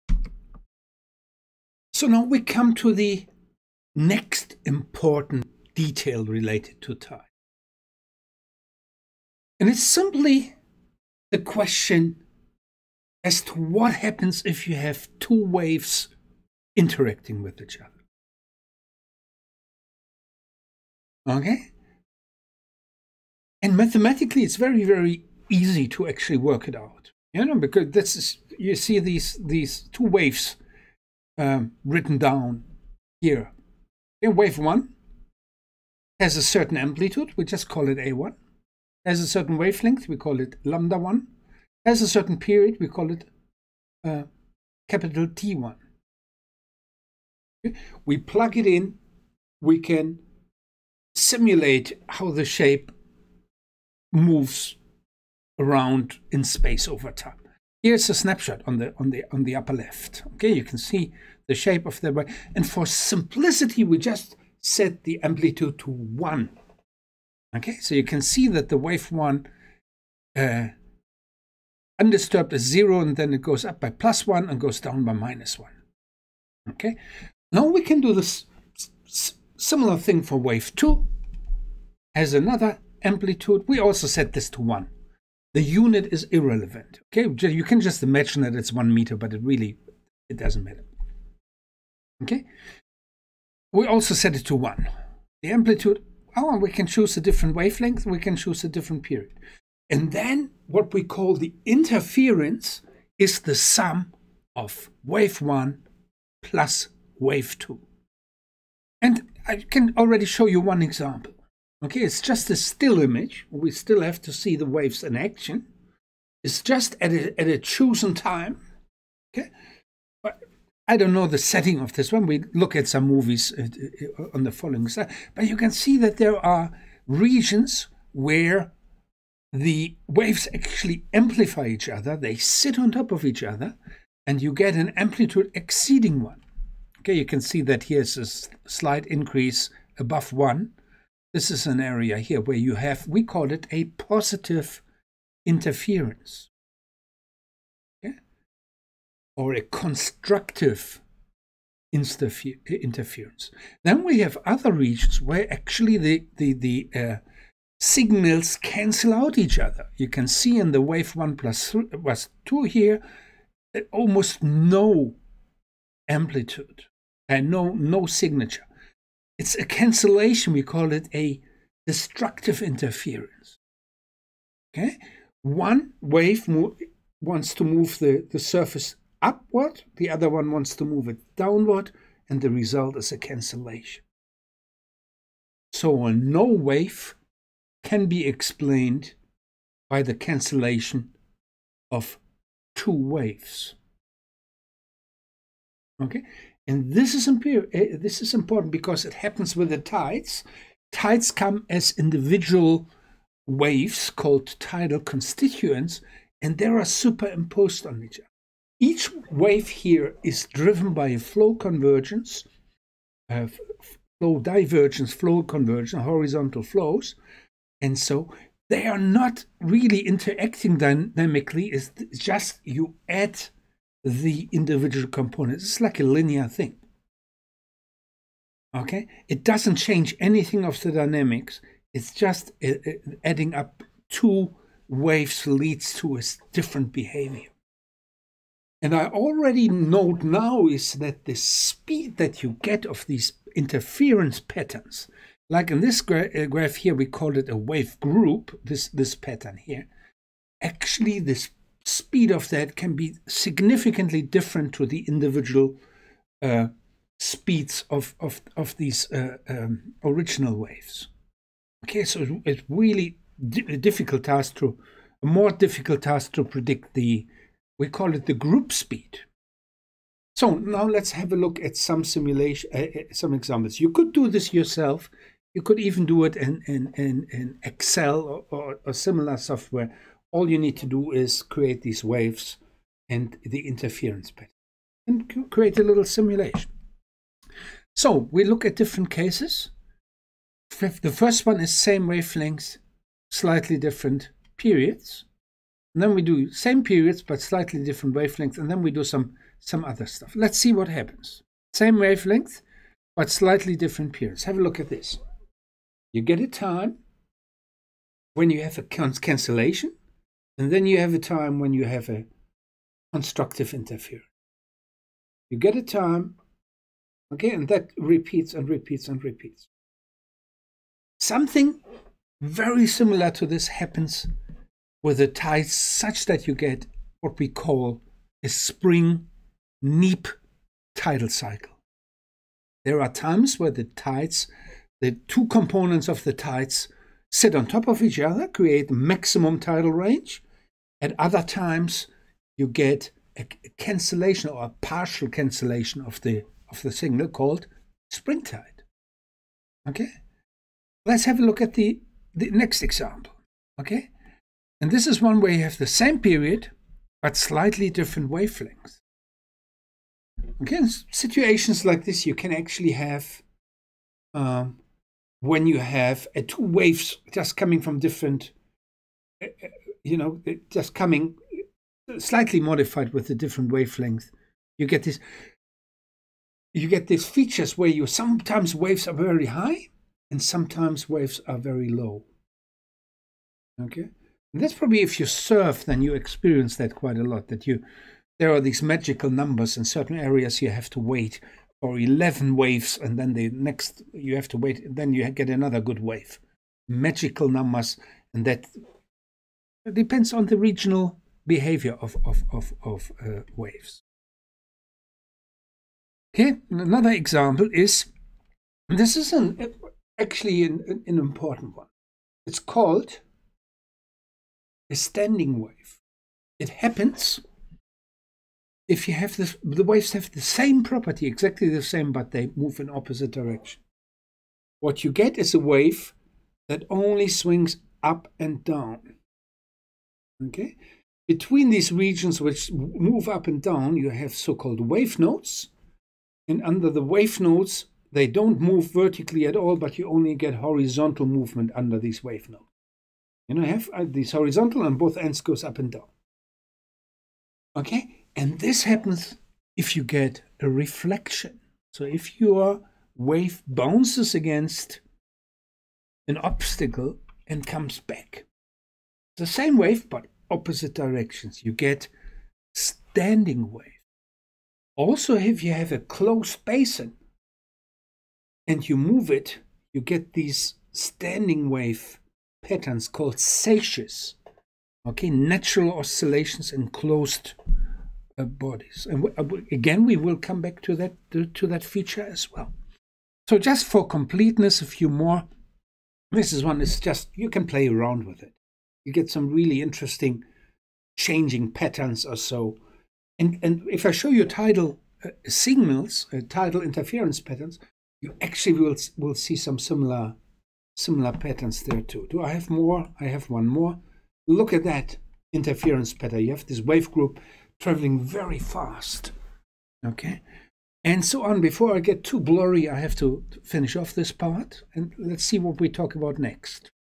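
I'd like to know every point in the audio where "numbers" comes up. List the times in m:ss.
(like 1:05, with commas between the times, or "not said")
6:29, 6:37.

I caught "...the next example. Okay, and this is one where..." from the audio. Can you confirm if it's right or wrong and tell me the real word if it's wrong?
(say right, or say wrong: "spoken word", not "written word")
right.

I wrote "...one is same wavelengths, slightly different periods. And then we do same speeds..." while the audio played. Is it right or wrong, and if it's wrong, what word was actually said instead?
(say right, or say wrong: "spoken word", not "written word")
wrong: "periods", not "speeds".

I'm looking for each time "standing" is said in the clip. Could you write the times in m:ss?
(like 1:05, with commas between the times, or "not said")
6:54, 7:42, 7:50.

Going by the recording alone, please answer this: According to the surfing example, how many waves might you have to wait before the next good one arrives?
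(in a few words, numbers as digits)
11.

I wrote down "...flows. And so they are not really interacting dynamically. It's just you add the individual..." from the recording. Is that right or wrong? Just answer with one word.
right.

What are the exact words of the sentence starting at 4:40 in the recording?
All you need to do is create these waves and the interference pattern and create a little simulation.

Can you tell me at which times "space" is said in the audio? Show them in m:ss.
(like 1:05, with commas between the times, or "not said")
0:56.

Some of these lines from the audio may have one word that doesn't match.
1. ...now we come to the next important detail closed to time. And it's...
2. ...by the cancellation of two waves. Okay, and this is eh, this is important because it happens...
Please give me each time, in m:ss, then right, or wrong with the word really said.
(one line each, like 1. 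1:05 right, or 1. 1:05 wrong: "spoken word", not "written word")
1. 0:02 wrong: "related", not "closed"
2. 3:09 right.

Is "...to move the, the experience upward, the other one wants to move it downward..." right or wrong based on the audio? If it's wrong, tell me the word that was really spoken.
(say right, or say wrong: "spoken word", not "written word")
wrong: "surface", not "experience".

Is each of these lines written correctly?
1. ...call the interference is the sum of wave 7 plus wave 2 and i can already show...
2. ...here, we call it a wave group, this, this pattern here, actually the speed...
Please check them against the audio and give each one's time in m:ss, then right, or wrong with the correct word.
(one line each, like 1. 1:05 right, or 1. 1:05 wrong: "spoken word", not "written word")
1. 1:41 wrong: "1", not "7"
2. 4:06 right.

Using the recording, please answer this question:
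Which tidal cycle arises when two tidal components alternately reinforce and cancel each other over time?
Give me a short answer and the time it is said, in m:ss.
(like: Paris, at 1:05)
spring neap tidal cycle, at 5:28.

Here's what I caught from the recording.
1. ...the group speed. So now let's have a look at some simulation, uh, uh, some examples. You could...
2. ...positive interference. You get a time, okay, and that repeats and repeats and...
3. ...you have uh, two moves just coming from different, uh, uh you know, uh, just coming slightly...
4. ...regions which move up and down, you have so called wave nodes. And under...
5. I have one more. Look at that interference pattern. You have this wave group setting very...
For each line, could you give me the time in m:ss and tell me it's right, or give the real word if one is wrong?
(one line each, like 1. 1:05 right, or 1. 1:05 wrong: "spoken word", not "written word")
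1. 4:28 right
2. 5:13 wrong: "constructive", not "positive"
3. 6:05 wrong: "waves", not "moves"
4. 7:11 right
5. 8:23 wrong: "traveling", not "setting".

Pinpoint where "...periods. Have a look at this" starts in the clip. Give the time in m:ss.
5:04.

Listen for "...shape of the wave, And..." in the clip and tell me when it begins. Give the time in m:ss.
1:01.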